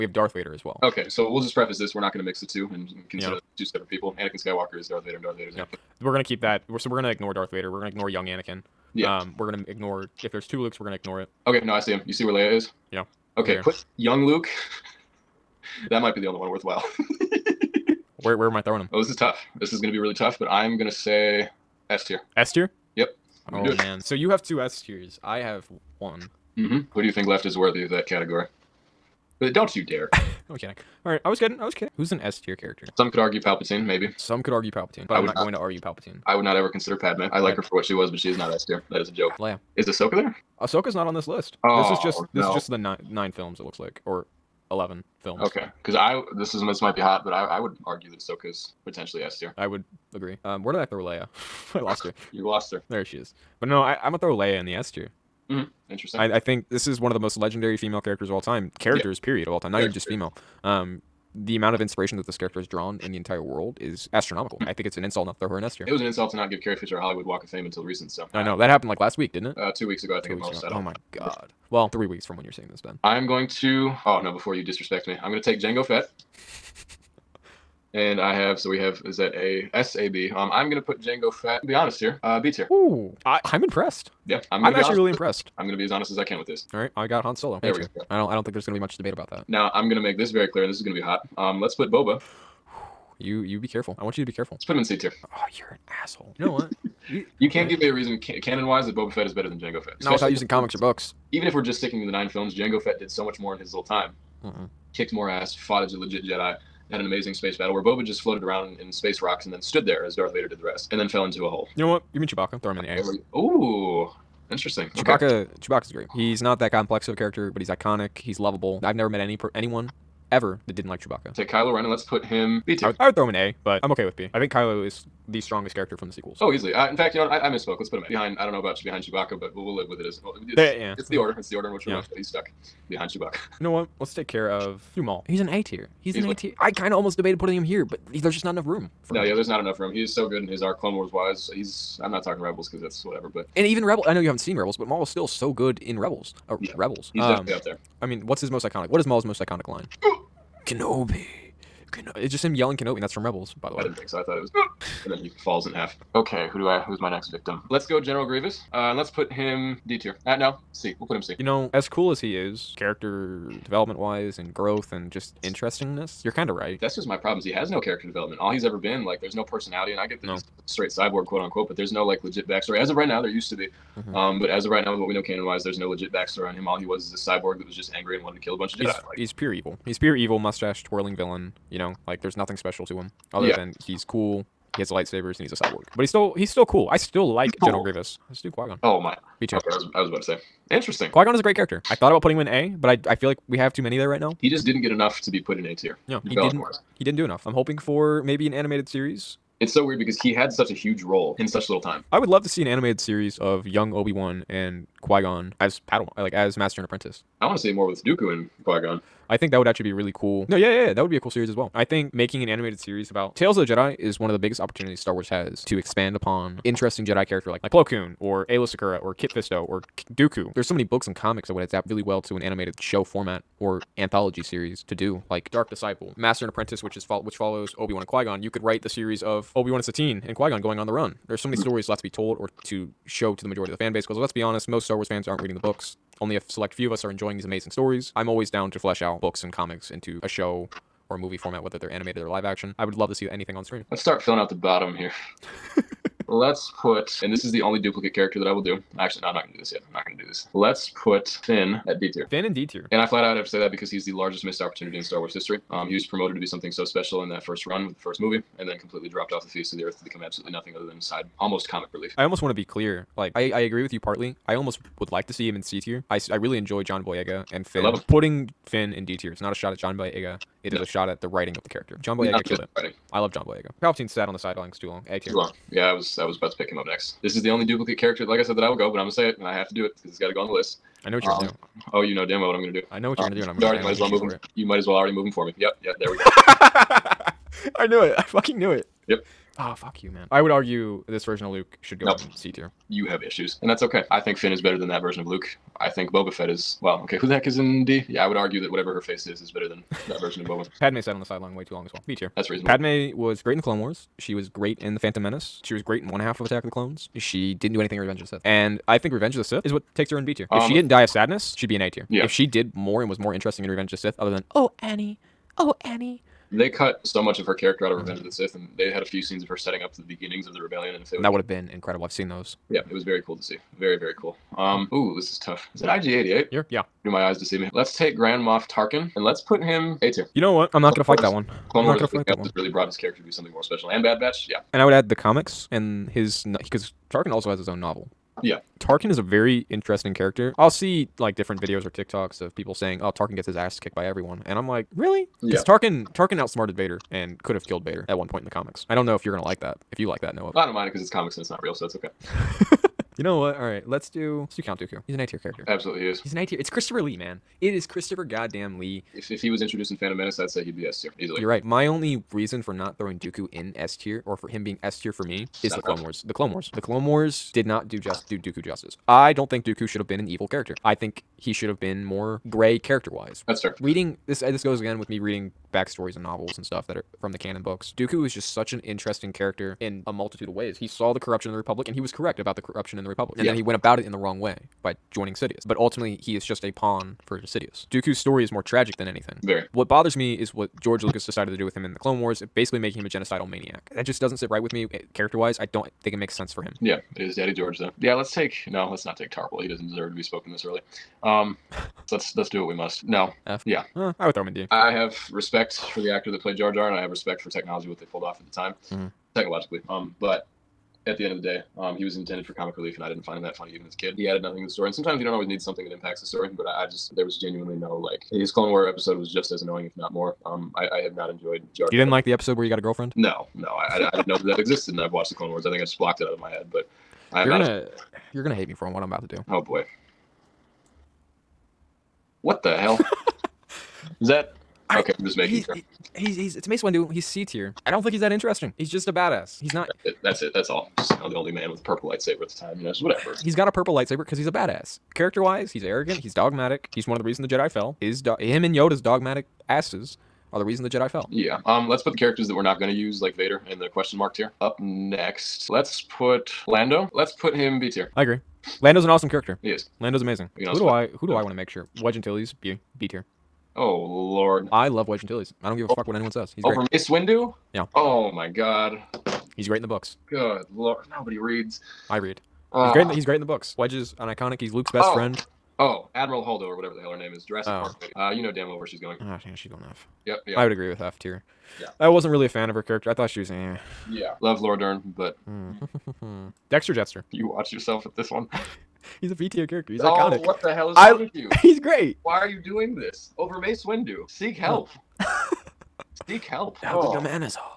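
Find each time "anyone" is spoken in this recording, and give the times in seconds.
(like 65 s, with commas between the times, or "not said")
119 s, 466 s.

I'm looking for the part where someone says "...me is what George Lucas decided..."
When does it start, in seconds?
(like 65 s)
390 s.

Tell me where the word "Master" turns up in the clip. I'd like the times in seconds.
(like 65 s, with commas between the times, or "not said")
206 s, 226 s.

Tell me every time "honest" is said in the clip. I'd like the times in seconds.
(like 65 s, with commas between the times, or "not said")
81 s, 85 s, 234 s.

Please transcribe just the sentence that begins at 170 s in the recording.
no straight cyborg, quote unquote, but there's no like legit backstory.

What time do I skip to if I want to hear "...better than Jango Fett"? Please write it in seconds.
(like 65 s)
99 s.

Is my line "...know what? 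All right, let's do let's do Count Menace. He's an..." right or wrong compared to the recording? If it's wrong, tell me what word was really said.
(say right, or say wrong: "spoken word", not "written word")
wrong: "Dooku", not "Menace".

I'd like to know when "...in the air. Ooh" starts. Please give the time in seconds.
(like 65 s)
112 s.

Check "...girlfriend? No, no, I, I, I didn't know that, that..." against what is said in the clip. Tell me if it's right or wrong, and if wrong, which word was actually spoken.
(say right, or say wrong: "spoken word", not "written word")
right.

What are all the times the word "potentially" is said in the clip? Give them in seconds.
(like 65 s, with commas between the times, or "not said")
48 s.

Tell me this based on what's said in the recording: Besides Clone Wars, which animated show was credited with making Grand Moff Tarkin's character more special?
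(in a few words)
Bad Batch.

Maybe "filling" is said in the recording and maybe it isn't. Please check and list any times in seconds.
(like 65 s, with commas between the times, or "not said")
244 s.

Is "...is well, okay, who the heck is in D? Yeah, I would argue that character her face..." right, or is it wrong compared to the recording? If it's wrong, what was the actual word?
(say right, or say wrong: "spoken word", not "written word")
wrong: "whatever", not "character".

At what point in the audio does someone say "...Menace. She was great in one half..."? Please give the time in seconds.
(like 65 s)
305 s.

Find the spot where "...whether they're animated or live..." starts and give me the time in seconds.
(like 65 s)
241 s.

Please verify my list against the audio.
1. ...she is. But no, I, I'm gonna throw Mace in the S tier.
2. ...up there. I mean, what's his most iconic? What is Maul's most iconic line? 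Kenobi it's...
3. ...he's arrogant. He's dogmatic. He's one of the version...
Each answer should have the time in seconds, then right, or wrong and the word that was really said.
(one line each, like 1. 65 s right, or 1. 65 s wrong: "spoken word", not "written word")
1. 53 s wrong: "Leia", not "Mace"
2. 147 s right
3. 445 s wrong: "reason", not "version".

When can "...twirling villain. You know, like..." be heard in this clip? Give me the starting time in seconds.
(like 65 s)
180 s.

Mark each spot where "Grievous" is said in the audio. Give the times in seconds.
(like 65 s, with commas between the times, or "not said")
158 s, 187 s.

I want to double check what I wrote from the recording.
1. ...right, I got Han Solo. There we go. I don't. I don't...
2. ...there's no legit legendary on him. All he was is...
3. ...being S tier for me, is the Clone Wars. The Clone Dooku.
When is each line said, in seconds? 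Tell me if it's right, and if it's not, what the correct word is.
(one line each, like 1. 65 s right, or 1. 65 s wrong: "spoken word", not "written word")
1. 86 s right
2. 175 s wrong: "backstory", not "legendary"
3. 364 s wrong: "Wars", not "Dooku".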